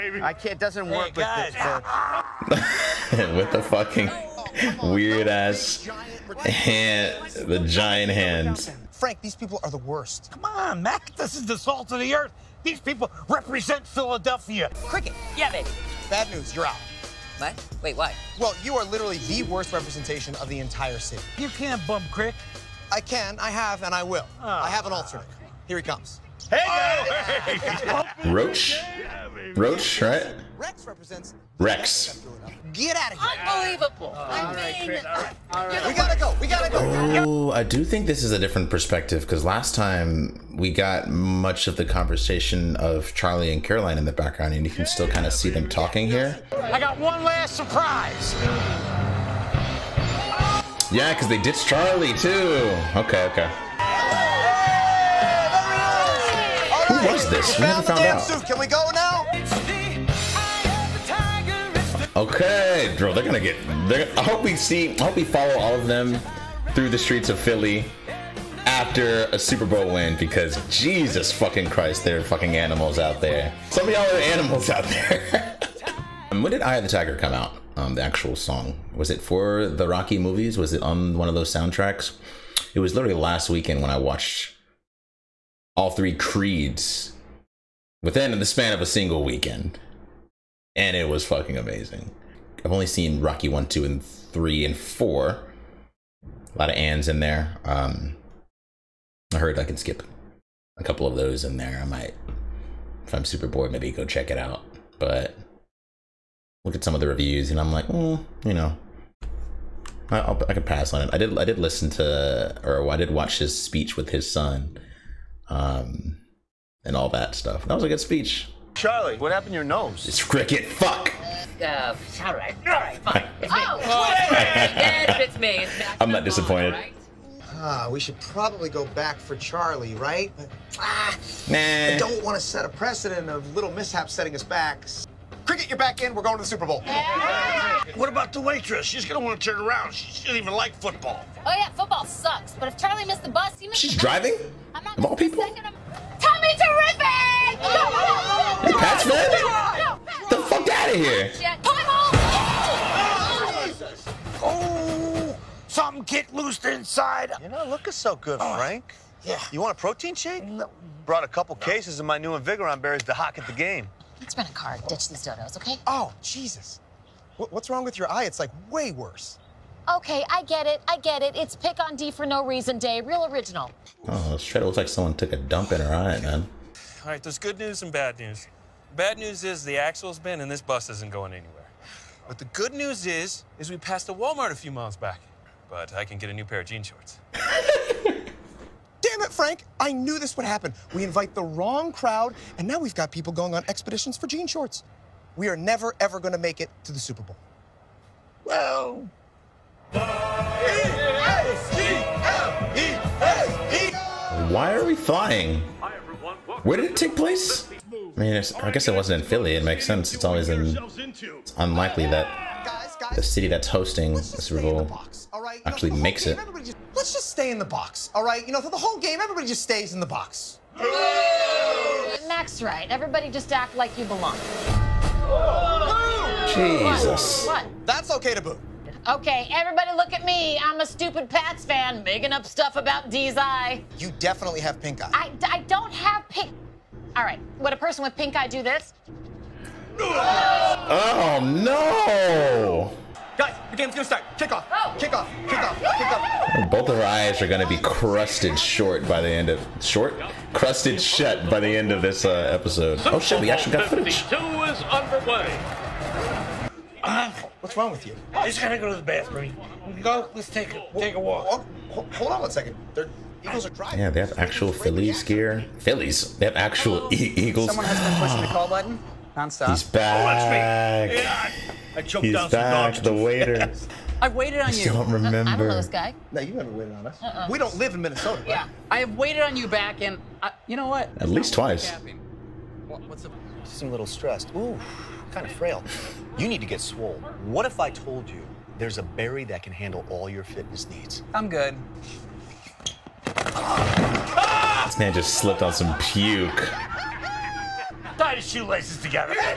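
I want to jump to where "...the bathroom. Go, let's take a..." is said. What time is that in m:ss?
4:18.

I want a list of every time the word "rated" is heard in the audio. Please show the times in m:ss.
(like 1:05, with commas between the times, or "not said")
not said.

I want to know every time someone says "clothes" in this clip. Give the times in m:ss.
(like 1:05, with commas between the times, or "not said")
not said.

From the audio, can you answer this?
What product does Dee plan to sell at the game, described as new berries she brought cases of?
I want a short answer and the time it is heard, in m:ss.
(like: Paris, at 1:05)
Invigoron berries, at 2:42.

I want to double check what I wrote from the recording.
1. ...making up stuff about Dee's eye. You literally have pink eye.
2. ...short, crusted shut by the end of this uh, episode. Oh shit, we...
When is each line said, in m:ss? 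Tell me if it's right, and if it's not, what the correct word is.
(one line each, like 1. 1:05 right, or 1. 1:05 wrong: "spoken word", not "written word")
1. 3:52 wrong: "definitely", not "literally"
2. 4:09 right.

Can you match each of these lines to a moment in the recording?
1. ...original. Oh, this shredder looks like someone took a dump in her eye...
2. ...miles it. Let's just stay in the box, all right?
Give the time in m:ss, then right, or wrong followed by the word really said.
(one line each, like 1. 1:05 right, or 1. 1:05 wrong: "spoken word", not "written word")
1. 2:53 right
2. 3:35 wrong: "makes", not "miles".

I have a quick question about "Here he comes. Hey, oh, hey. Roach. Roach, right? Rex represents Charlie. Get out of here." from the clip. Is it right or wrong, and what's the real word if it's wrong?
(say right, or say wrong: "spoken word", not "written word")
wrong: "Rex", not "Charlie".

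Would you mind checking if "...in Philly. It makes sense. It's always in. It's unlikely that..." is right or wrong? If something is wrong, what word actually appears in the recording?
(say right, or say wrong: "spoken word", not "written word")
right.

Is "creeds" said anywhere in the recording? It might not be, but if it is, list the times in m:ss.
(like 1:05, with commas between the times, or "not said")
1:26.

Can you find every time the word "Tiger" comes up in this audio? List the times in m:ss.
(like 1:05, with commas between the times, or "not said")
1:16.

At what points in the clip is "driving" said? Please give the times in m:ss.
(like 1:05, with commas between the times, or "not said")
2:23, 4:23.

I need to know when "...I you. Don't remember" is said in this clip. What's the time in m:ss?
4:34.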